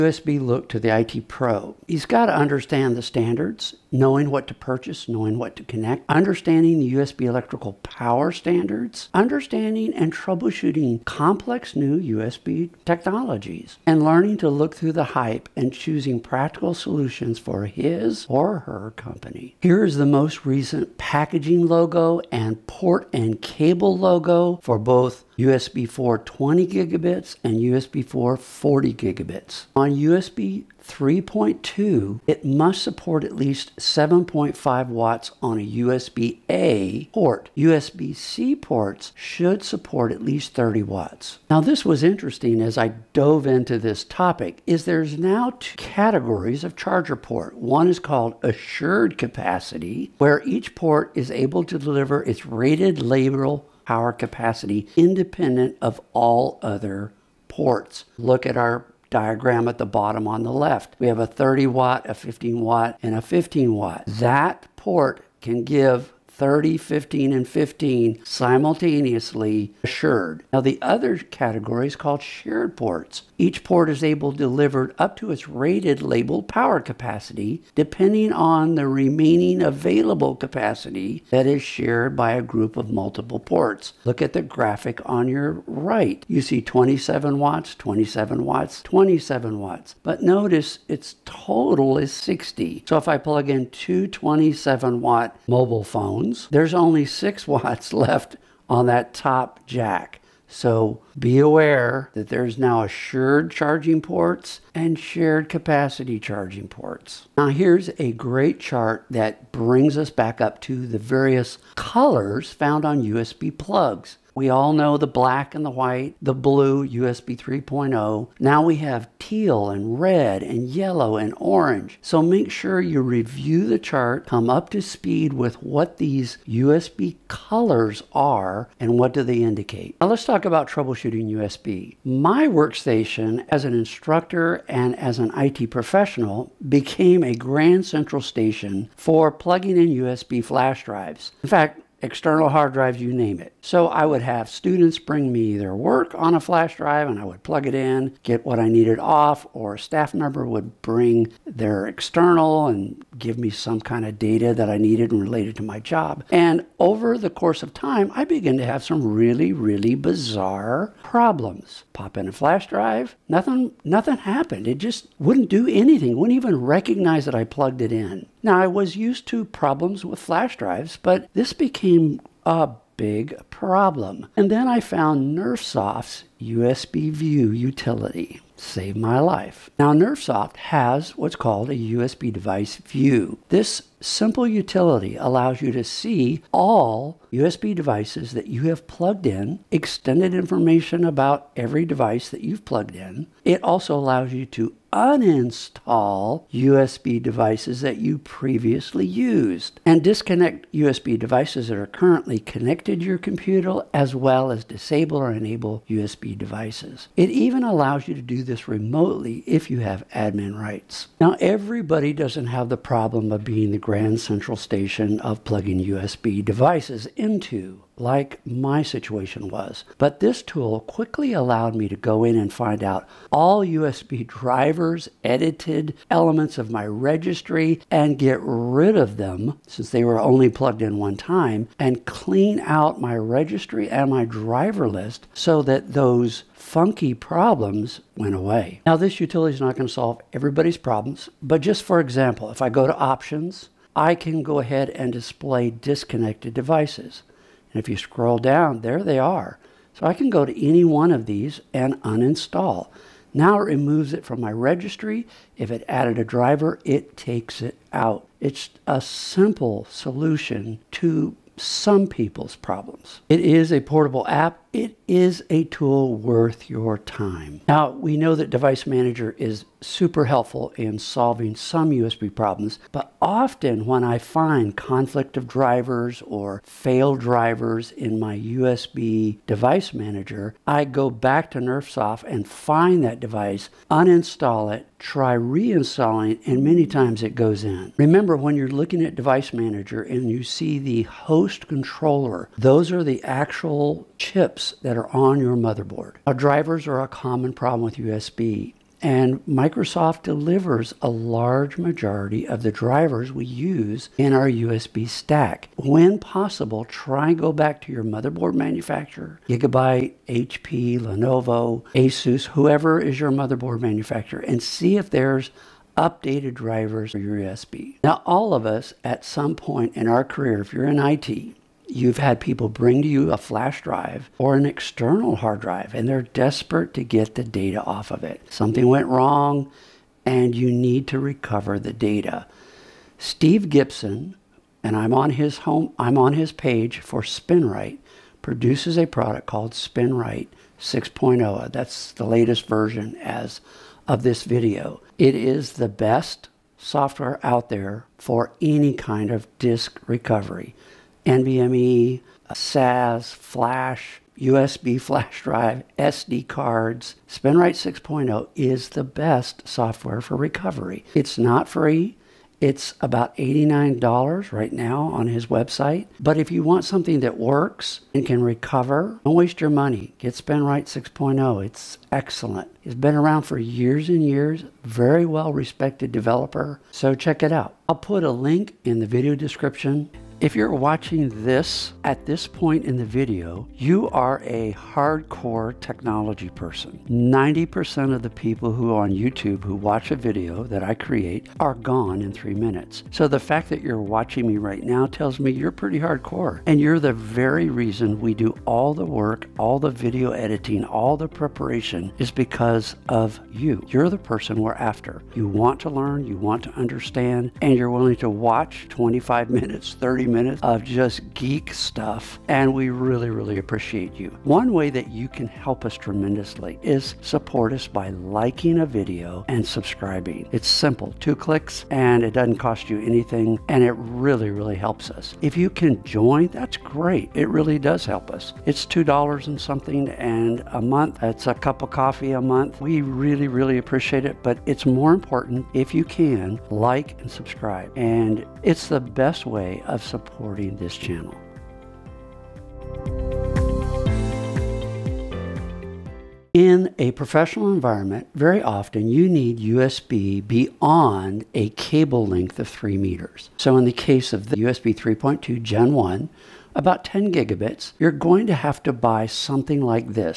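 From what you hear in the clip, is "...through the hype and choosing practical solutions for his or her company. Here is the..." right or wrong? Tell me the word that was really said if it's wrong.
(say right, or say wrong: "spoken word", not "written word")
right.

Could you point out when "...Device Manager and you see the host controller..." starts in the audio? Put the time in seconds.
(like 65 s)
289 s.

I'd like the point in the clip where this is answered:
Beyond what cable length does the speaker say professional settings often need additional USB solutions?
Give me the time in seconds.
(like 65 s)
452 s.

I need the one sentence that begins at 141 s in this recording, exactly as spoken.
In fact, external hard drives, you name it.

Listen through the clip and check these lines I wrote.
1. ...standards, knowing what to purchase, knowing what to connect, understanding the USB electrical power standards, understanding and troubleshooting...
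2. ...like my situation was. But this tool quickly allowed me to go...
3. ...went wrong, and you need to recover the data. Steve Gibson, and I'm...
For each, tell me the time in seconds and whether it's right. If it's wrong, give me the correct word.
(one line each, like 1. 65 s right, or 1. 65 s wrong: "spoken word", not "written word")
1. 3 s right
2. 218 s right
3. 328 s right.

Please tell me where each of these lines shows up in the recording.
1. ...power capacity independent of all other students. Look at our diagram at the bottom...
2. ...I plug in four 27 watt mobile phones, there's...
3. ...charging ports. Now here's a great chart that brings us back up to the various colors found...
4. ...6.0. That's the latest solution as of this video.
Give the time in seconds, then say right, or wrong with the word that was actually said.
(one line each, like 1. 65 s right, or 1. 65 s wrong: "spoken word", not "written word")
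1. 53 s wrong: "ports", not "students"
2. 93 s wrong: "two", not "four"
3. 106 s right
4. 340 s wrong: "version", not "solution".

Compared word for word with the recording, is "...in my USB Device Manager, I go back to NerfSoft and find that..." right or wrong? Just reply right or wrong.
wrong.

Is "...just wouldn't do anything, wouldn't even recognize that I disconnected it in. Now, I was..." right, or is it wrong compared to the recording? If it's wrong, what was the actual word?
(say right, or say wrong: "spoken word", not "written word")
wrong: "plugged", not "disconnected".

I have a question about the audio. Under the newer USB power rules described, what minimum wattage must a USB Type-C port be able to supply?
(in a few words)
30 watts.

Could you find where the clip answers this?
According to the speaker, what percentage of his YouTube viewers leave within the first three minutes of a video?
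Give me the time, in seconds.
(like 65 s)
387 s.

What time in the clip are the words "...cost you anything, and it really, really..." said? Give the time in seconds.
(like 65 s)
422 s.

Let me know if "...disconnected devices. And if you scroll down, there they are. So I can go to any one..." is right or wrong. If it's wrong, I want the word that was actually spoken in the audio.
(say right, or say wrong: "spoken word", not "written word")
right.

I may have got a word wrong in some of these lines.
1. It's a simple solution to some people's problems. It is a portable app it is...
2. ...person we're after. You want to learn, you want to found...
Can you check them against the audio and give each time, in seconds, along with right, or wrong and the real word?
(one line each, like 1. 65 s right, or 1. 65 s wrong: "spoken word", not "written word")
1. 258 s right
2. 404 s wrong: "understand", not "found".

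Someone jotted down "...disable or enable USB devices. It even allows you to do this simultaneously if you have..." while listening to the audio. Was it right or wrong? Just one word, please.
wrong.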